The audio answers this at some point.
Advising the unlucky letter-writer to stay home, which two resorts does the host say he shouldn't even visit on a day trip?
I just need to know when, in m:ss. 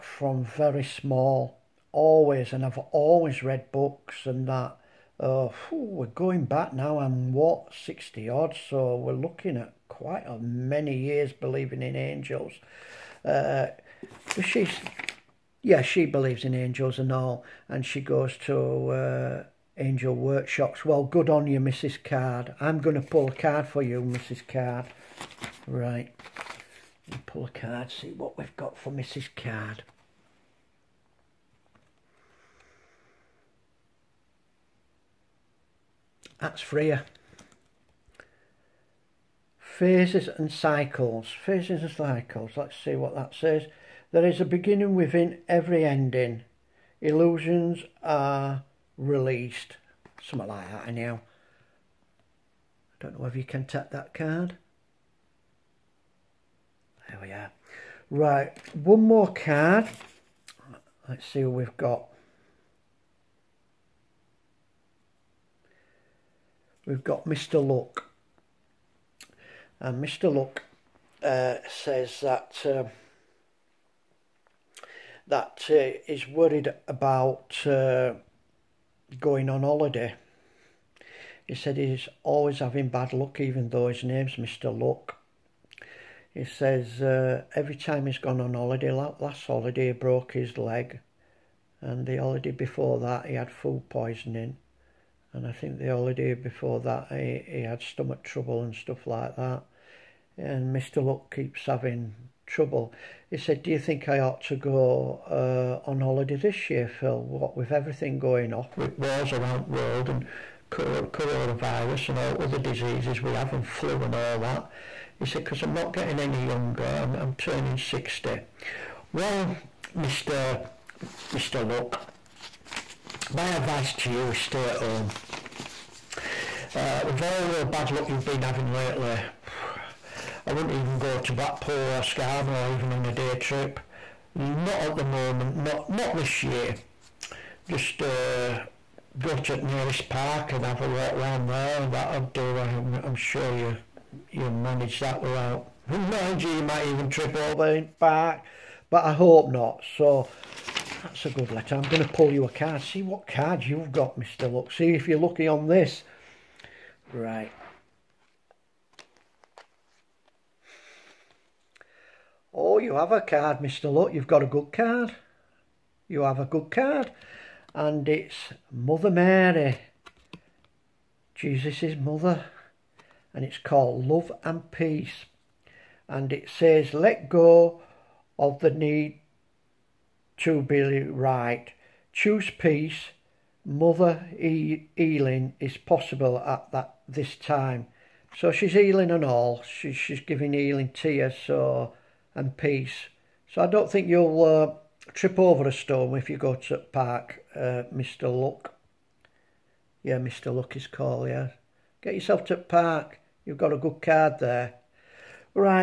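2:11.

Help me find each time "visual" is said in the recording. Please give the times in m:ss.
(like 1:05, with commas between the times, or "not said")
not said.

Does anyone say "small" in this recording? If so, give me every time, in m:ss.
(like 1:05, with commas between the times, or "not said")
0:00.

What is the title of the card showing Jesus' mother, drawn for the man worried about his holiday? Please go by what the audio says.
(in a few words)
Love and Peace.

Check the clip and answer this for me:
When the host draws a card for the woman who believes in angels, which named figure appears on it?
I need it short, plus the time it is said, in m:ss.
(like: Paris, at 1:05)
Freya, at 0:36.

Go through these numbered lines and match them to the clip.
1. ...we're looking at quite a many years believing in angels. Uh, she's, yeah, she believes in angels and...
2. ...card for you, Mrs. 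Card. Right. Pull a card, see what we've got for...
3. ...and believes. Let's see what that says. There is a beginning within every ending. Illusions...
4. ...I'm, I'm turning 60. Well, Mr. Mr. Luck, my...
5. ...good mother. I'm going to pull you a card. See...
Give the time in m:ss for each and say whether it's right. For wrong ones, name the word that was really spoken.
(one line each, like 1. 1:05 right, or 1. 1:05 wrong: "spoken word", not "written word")
1. 0:08 right
2. 0:23 right
3. 0:41 wrong: "cycles", not "believes"
4. 1:56 right
5. 2:31 wrong: "letter", not "mother".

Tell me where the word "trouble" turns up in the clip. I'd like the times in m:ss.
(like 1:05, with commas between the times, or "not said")
1:38, 1:42.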